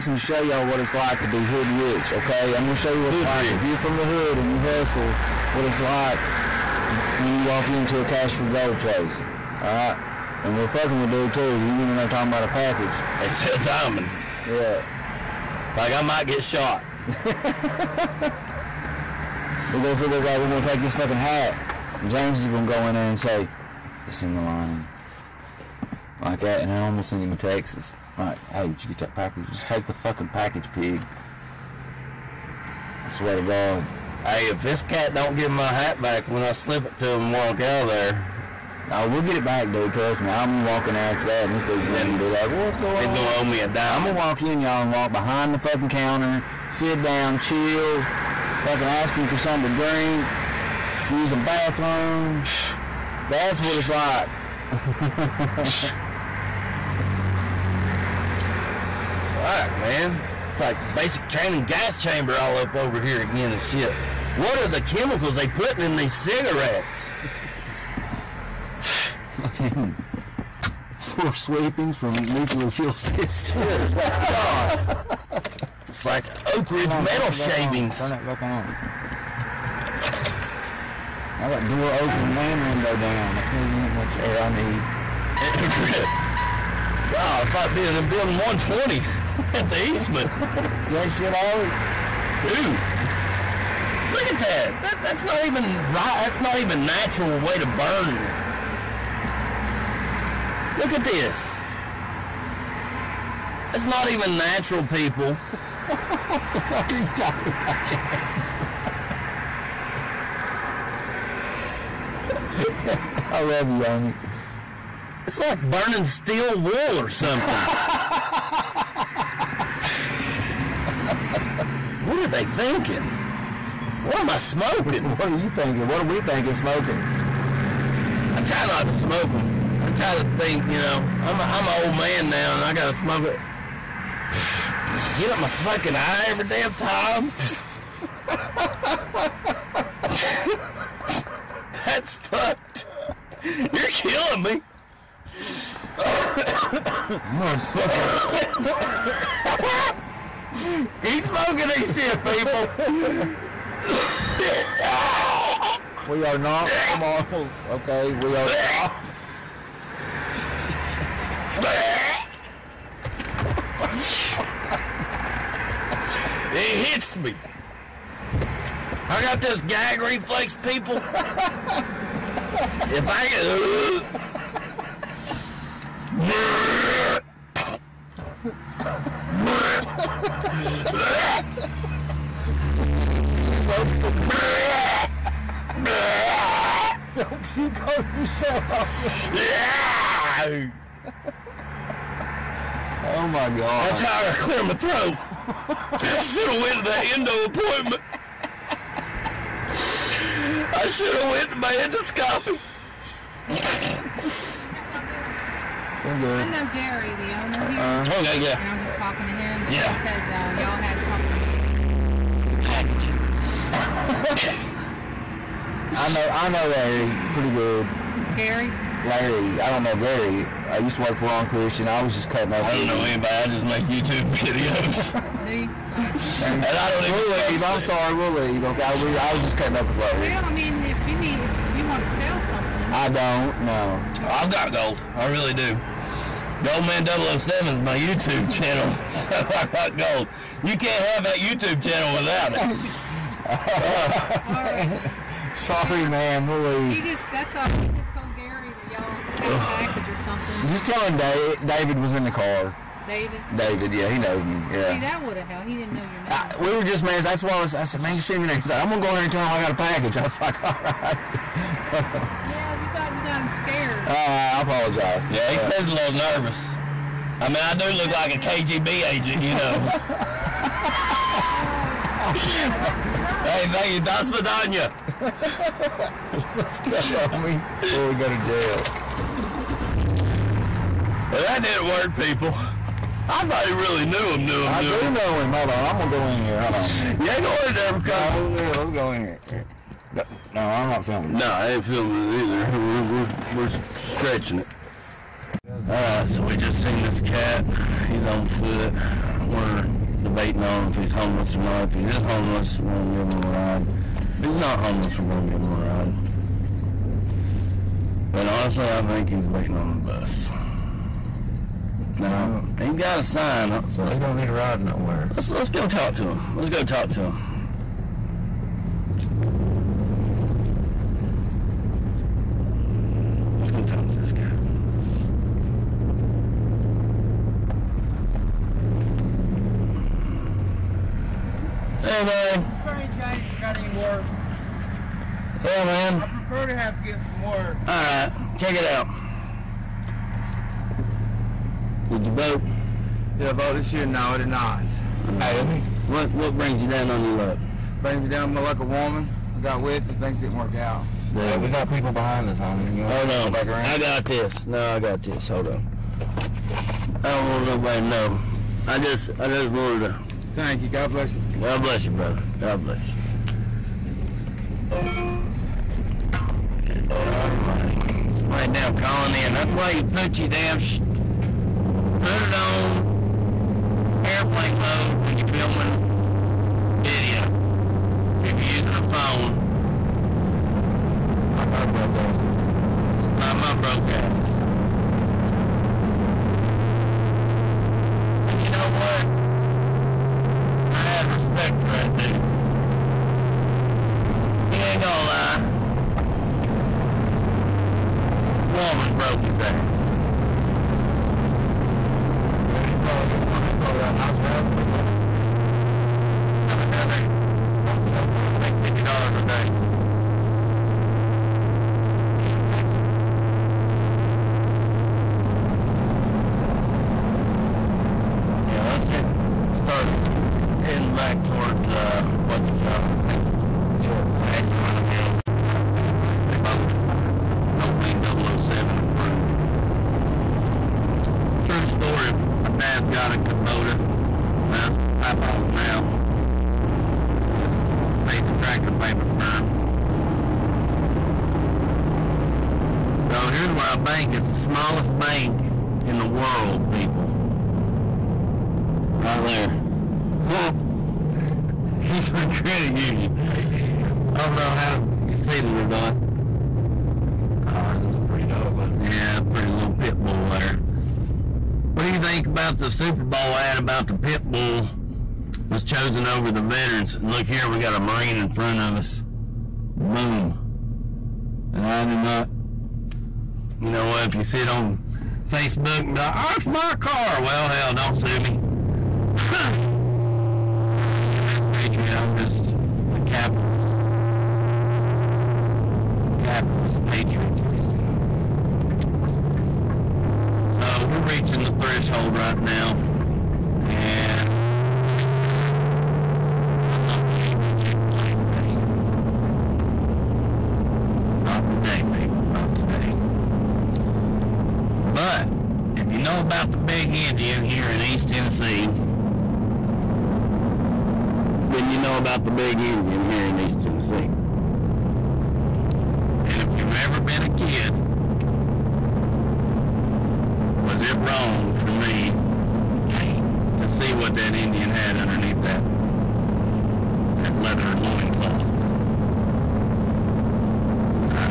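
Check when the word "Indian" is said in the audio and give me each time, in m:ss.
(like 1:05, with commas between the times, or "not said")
8:27, 8:32, 8:44.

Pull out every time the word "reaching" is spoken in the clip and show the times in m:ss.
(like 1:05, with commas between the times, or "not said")
8:11.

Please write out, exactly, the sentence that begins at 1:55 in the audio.
It's like burning steel wool or something.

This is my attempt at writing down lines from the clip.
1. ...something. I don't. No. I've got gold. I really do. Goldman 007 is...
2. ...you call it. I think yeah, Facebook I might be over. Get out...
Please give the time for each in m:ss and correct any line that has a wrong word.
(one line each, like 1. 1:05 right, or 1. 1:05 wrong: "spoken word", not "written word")
1. 3:52 right
2. 7:02 wrong: "Patsy", not "Facebook".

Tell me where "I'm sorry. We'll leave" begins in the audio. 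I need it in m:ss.
3:47.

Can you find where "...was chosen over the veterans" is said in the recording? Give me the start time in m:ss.
7:45.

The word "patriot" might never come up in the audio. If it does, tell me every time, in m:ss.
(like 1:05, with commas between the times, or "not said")
8:01, 8:07.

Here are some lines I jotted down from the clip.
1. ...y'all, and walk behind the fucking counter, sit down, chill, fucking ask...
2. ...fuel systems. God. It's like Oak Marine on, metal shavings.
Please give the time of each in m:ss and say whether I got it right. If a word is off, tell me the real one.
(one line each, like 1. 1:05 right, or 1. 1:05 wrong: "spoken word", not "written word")
1. 0:44 right
2. 1:12 wrong: "Ridge", not "Marine".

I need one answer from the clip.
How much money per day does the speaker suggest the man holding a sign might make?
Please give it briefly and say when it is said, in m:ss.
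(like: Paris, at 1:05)
$50, at 6:48.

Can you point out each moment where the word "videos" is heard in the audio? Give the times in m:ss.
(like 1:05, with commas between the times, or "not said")
3:44, 6:16.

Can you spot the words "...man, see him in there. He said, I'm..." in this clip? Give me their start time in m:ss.
4:18.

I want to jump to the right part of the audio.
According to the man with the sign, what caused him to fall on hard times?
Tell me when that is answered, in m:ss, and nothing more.
5:48.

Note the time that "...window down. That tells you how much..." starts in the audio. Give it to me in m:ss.
1:22.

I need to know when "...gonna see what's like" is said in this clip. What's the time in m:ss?
0:19.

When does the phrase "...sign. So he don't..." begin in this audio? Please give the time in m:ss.
5:13.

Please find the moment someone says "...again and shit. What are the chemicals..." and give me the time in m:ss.
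1:03.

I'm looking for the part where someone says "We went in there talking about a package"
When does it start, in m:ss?
0:11.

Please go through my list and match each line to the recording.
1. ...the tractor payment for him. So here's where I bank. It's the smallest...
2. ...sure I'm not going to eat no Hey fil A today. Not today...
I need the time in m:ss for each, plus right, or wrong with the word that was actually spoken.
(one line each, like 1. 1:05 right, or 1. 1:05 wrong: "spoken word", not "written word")
1. 7:18 right
2. 8:15 wrong: "Chick", not "Hey".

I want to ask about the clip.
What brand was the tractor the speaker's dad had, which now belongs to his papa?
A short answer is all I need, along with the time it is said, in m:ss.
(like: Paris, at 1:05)
Kubota, at 7:13.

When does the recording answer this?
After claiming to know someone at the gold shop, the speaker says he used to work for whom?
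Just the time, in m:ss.
3:41.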